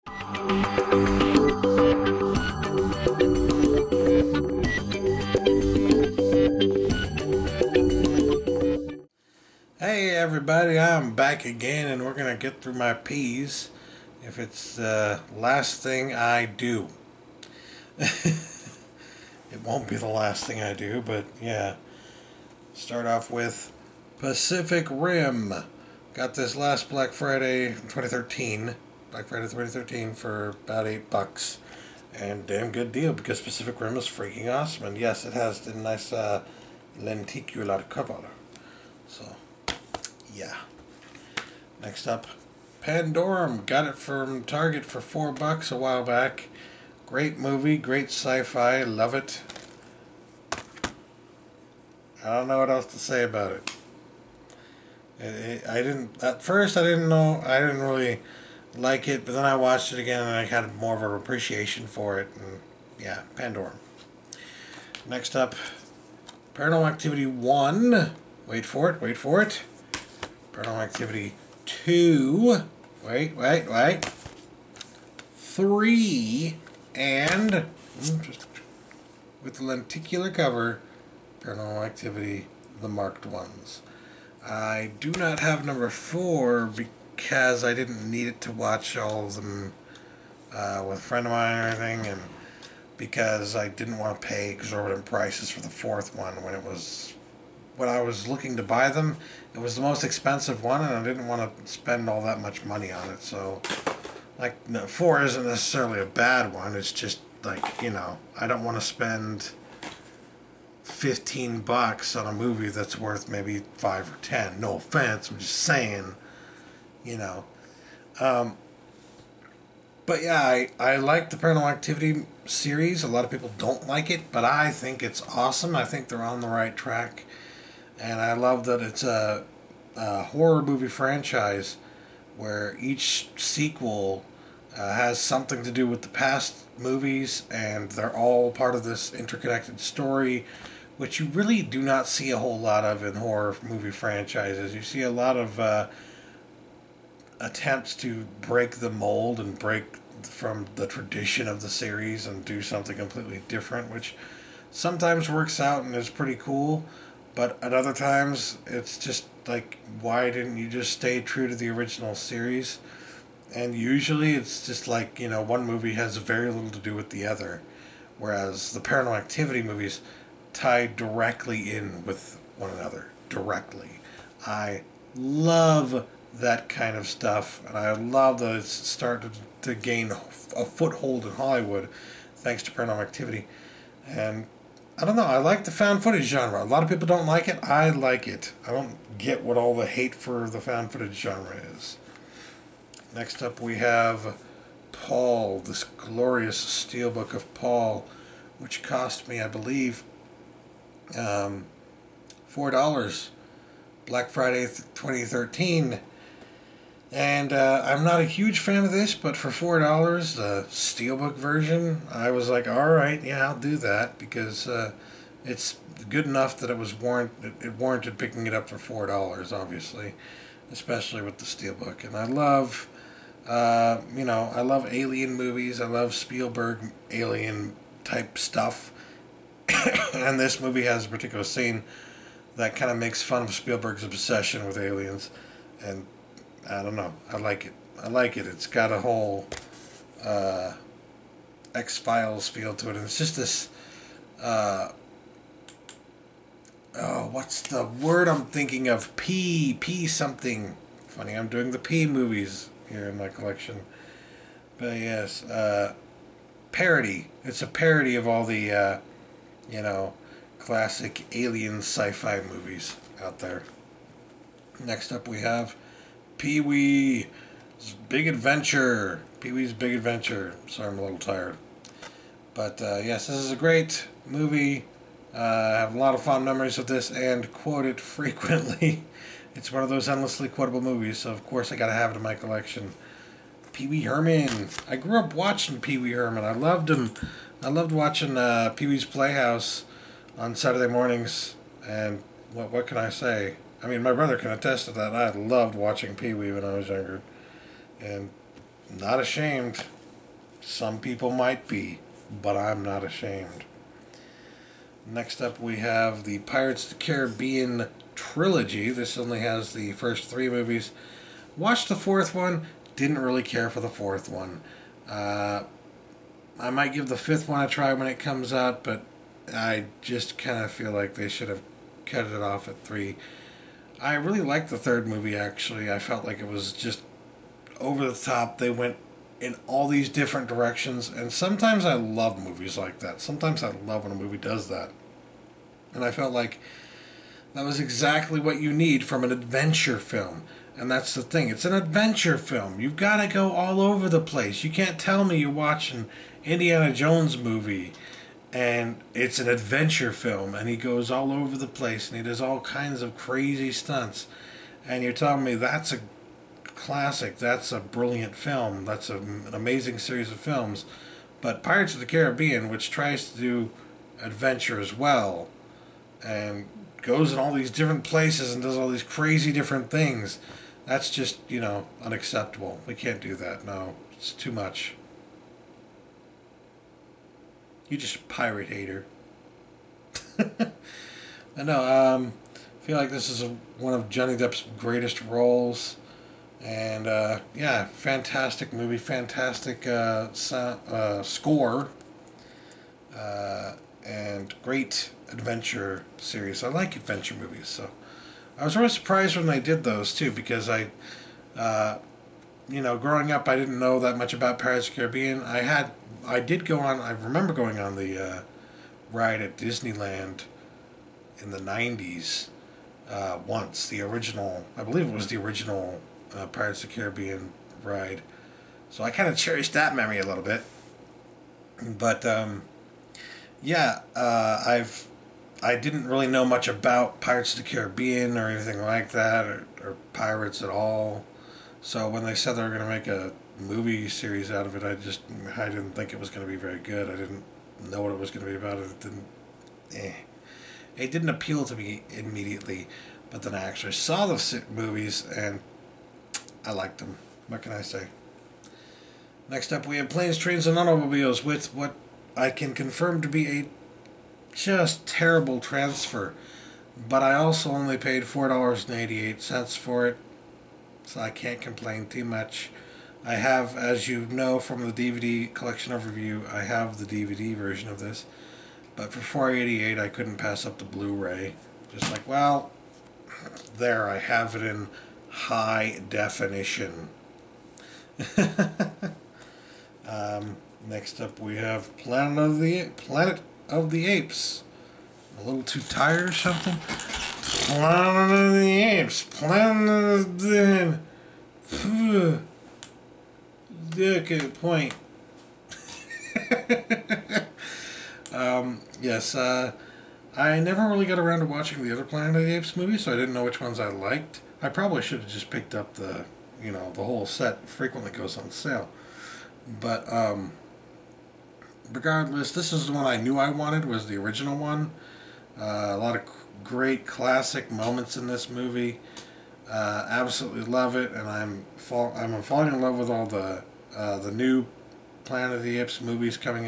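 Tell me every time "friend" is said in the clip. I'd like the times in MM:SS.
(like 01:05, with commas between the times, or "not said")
01:31.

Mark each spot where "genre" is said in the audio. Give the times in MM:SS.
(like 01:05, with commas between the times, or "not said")
03:06, 03:11.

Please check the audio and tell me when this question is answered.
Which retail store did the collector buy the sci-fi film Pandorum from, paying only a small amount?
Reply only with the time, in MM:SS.
00:44.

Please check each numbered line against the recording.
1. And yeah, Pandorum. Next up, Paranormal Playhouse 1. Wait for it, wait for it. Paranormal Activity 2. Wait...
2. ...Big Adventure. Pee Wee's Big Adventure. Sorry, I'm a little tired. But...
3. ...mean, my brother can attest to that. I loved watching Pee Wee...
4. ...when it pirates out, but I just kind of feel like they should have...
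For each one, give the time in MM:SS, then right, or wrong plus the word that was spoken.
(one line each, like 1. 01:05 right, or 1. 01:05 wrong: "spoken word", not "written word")
1. 01:02 wrong: "Activity", not "Playhouse"
2. 04:28 right
3. 04:53 right
4. 05:17 wrong: "comes", not "pirates".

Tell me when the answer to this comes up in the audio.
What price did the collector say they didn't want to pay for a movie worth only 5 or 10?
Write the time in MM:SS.
01:50.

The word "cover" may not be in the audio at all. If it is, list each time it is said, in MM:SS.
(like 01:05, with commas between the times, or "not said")
00:37, 01:20.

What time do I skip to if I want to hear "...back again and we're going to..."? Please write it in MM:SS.
00:11.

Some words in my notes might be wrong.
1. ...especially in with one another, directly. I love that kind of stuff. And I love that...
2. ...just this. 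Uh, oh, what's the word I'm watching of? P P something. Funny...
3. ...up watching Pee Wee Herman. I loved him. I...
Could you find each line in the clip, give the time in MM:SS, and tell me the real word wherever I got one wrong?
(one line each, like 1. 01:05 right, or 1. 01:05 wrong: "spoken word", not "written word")
1. 02:50 wrong: "directly", not "especially"
2. 04:03 wrong: "thinking", not "watching"
3. 04:45 right.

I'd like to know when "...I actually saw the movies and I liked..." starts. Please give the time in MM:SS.
07:23.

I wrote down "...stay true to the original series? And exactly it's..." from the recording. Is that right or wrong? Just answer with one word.
wrong.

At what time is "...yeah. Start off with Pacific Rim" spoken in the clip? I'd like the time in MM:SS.
00:21.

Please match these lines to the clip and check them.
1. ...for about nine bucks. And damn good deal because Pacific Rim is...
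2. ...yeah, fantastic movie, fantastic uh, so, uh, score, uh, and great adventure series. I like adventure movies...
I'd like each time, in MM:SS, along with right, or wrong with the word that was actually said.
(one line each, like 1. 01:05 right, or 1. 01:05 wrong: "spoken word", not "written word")
1. 00:30 wrong: "eight", not "nine"
2. 06:27 right.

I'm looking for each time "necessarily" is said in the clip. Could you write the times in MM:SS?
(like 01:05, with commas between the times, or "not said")
01:45.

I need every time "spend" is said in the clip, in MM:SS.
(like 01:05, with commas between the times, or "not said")
01:41, 01:48.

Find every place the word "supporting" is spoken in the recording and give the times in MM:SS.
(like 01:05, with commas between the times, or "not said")
not said.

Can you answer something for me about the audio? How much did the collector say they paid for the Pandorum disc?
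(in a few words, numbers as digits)
$4.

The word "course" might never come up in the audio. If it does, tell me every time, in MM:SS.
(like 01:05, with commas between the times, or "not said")
04:41.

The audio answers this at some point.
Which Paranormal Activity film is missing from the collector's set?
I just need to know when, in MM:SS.
01:25.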